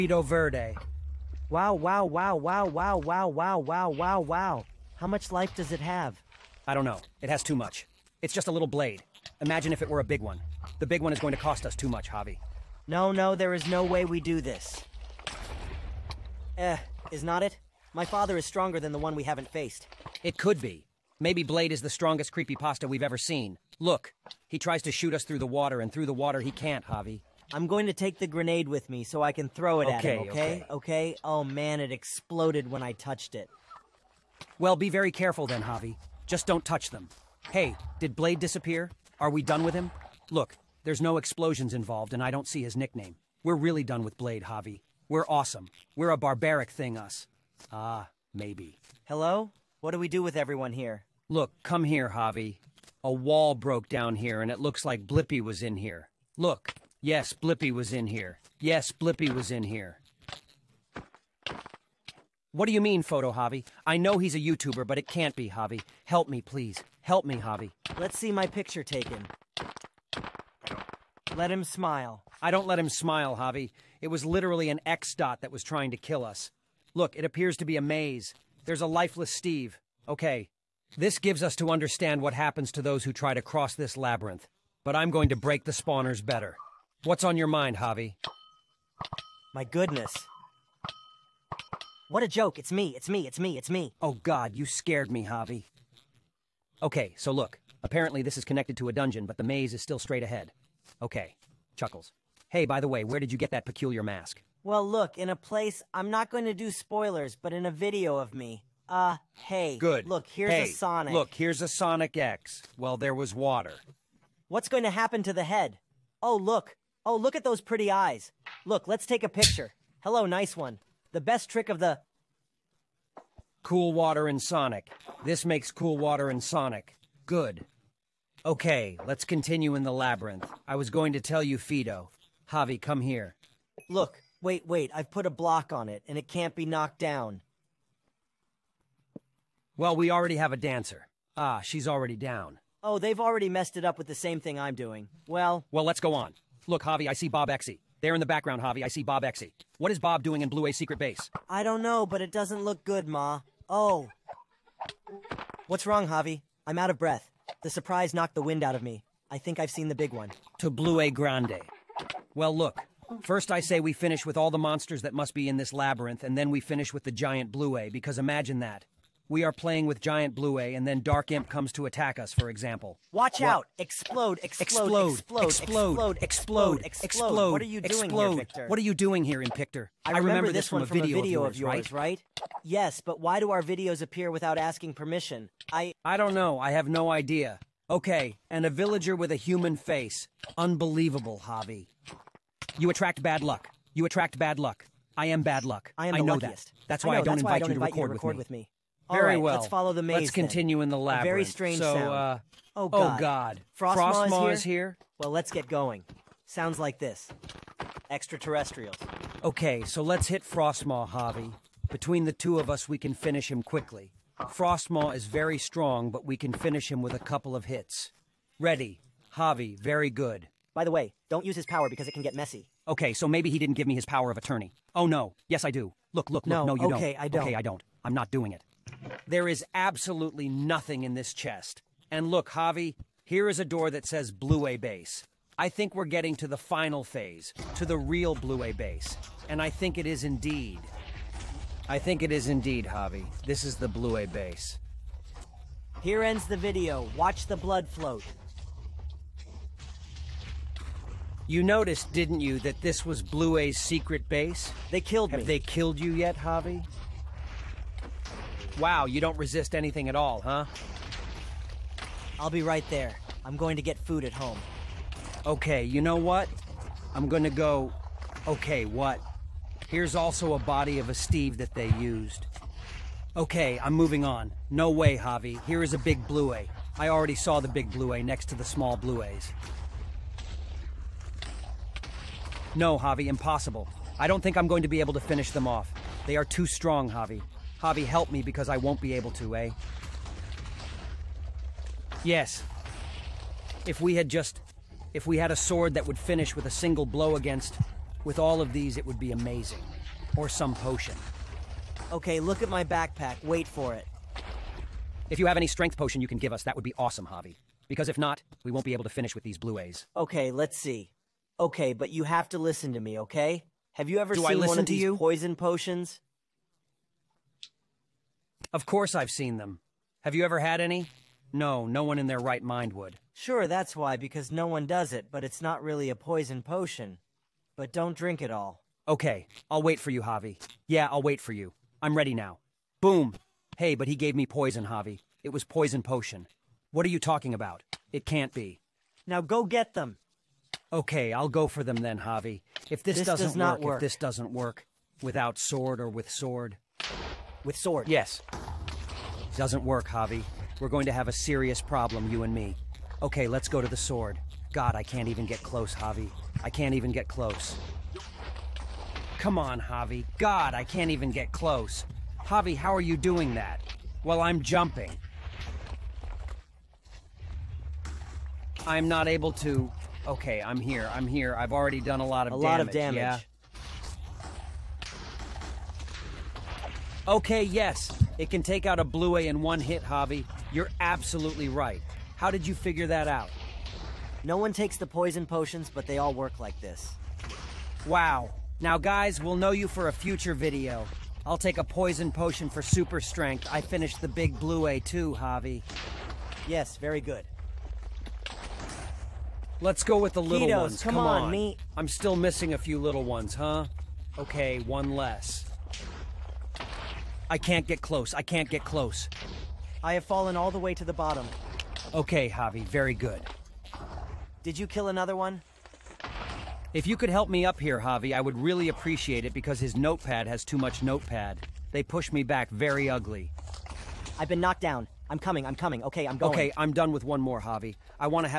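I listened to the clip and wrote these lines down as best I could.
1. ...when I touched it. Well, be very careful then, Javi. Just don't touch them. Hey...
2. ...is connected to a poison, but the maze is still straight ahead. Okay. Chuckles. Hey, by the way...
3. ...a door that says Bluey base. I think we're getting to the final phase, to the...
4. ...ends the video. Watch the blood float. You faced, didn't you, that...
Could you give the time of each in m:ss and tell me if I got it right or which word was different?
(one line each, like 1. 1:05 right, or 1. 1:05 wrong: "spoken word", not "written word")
1. 0:32 right
2. 1:38 wrong: "dungeon", not "poison"
3. 3:53 right
4. 4:06 wrong: "noticed", not "faced".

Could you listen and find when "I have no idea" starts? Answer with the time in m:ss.
3:06.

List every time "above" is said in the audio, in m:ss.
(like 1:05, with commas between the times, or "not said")
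not said.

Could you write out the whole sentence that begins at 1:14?
It was literally an X dot that was trying to kill us.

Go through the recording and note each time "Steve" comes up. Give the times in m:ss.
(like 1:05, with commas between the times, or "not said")
1:19, 4:31.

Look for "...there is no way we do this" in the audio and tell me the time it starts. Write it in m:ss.
0:13.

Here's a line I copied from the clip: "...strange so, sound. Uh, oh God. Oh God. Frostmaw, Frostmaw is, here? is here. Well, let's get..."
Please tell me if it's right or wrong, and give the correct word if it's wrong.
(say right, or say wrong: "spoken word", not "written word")
right.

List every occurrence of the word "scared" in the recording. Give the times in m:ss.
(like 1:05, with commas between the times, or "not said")
1:34.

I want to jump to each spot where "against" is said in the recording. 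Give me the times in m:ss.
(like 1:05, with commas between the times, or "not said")
4:57.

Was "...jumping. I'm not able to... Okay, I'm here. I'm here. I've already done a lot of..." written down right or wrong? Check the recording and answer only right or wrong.
right.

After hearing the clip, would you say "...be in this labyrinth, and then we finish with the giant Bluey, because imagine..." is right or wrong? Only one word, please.
right.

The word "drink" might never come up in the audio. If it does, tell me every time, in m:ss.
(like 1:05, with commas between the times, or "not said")
5:28.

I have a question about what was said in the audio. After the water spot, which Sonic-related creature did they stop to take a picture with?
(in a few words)
Sonic X.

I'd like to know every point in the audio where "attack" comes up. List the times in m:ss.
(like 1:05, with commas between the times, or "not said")
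2:51.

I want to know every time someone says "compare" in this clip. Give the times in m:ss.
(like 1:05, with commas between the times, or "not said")
not said.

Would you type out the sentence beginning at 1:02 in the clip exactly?
What do you mean, Photo Javi?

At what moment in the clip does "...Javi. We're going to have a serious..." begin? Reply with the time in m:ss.
5:50.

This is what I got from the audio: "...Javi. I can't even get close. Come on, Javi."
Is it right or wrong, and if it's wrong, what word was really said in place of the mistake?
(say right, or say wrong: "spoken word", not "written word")
right.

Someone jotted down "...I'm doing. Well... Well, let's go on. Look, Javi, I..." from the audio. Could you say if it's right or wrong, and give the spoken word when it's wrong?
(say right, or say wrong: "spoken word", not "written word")
right.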